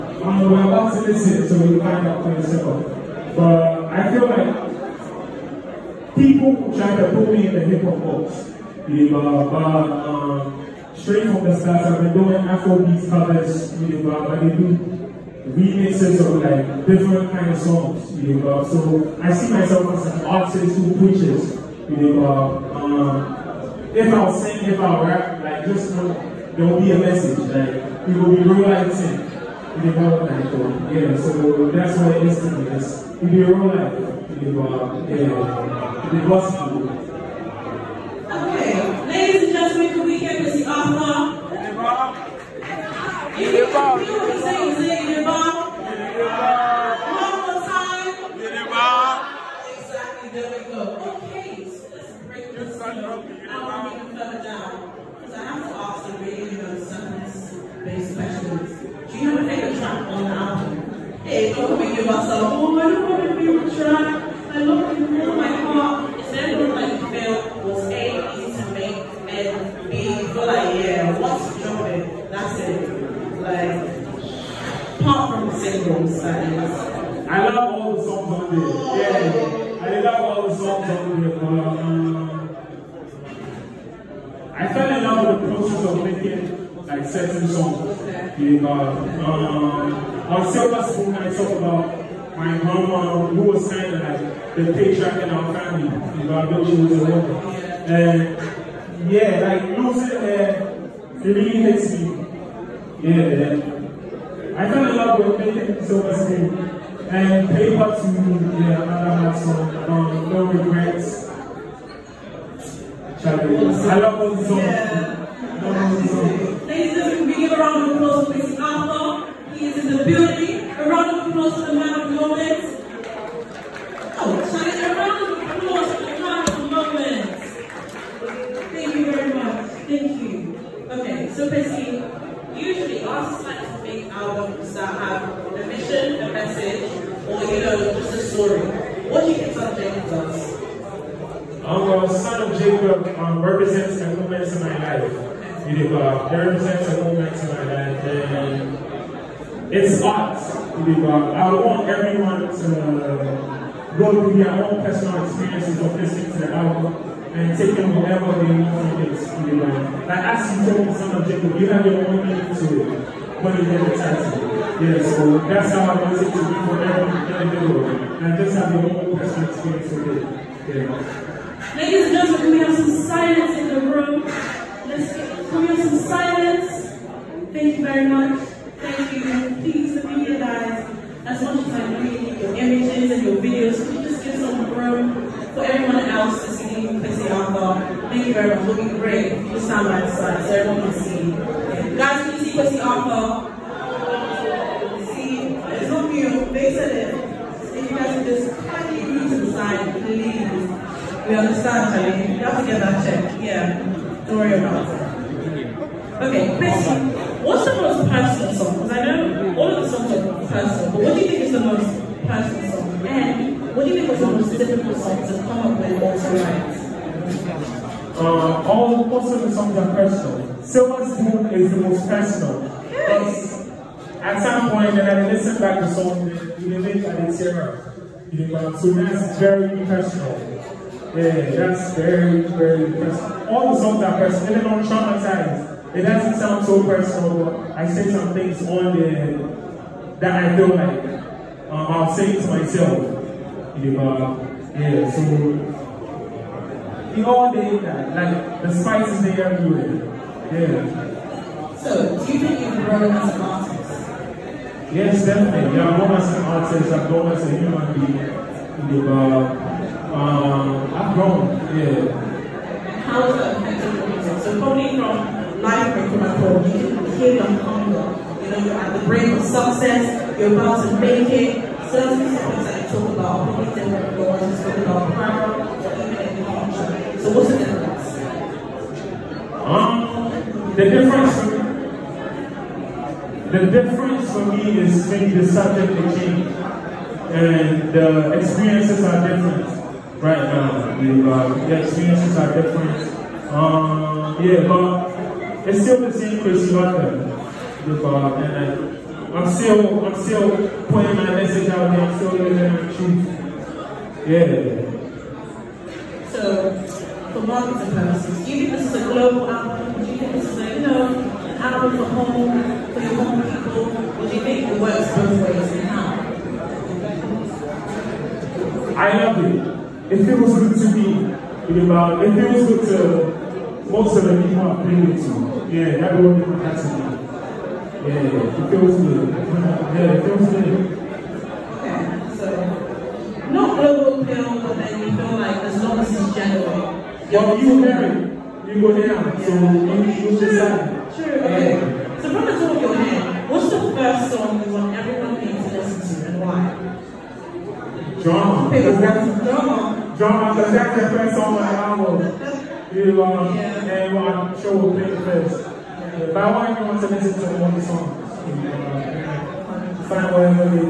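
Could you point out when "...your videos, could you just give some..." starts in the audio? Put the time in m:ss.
3:03.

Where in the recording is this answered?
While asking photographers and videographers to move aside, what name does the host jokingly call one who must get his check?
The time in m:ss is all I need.
3:21.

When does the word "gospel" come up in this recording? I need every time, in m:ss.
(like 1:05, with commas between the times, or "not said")
0:36.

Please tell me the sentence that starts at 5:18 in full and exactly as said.
I love it it feels good to be in about, it feels good to most of the people I've been with you.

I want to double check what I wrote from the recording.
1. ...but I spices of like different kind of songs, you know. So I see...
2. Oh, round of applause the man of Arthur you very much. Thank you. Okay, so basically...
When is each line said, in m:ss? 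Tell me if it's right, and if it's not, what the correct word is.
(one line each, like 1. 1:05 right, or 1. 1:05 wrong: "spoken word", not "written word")
1. 0:14 wrong: "remixes", not "spices"
2. 2:04 wrong: "Thank", not "Arthur".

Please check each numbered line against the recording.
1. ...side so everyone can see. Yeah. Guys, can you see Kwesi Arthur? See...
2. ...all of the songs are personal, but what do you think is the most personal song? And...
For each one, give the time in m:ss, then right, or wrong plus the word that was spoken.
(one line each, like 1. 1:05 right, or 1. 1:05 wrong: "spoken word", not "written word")
1. 3:10 right
2. 3:29 right.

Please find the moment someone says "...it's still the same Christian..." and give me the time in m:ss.
4:55.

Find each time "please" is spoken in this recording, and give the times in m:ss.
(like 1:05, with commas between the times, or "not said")
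2:59, 3:20.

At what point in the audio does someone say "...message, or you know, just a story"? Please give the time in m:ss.
2:16.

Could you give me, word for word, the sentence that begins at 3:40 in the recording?
Silver Moon is the most personal.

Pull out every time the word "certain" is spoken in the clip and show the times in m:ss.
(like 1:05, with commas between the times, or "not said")
1:27, 4:31.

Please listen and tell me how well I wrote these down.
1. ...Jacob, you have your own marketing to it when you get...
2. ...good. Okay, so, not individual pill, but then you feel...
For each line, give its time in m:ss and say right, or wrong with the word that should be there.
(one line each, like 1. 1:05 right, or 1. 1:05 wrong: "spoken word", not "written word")
1. 2:41 wrong: "meaning", not "marketing"
2. 5:30 wrong: "global", not "individual".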